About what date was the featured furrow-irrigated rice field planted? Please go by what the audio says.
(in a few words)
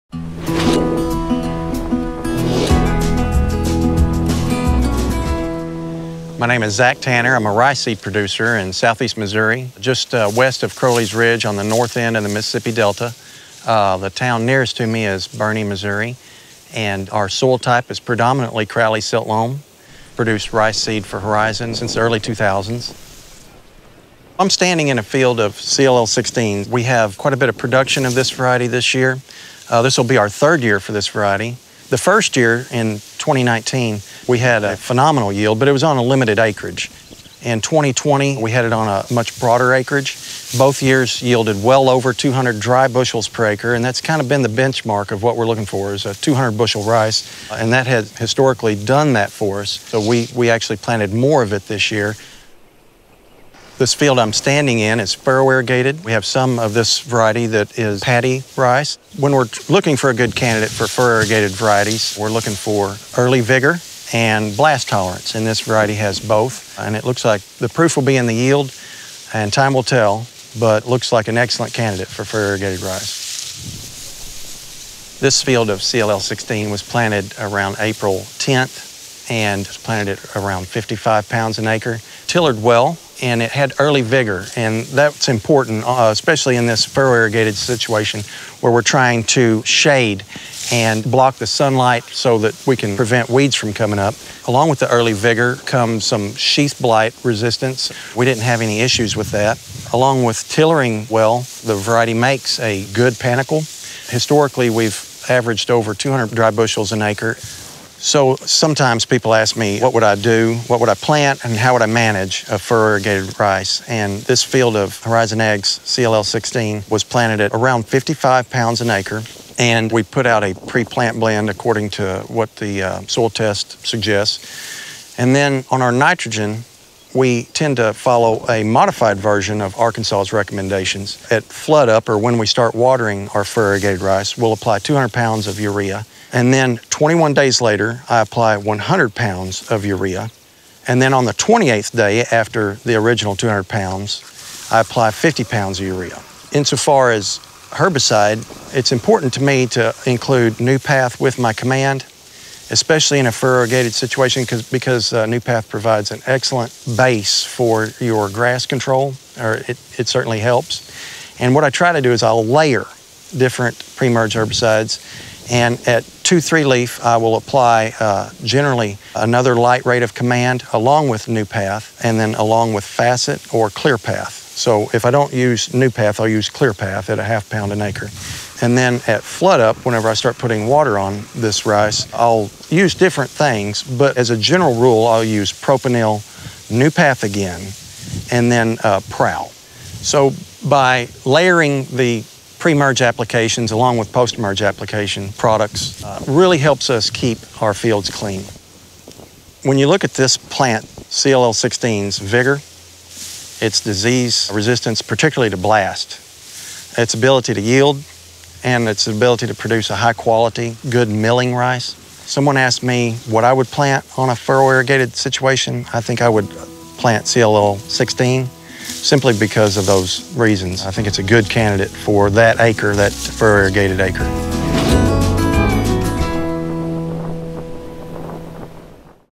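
April 10.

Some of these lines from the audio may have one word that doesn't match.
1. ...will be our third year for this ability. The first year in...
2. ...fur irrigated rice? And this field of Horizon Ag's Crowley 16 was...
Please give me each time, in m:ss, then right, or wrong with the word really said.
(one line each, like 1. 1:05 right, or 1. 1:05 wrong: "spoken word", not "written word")
1. 0:29 wrong: "variety", not "ability"
2. 1:52 wrong: "CLL", not "Crowley".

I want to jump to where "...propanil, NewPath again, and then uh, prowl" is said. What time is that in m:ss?
3:05.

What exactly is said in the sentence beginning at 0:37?
In 2020, we had it on a much broader acreage.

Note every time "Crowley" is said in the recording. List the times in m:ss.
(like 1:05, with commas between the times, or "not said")
0:10, 0:18.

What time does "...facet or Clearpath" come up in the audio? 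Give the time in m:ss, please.
2:52.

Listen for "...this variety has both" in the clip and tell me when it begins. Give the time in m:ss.
1:05.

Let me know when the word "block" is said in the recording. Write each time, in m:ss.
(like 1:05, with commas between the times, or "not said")
1:31.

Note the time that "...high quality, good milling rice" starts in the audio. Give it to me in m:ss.
3:29.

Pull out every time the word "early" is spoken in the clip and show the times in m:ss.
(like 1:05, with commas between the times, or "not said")
0:21, 1:03, 1:23, 1:34.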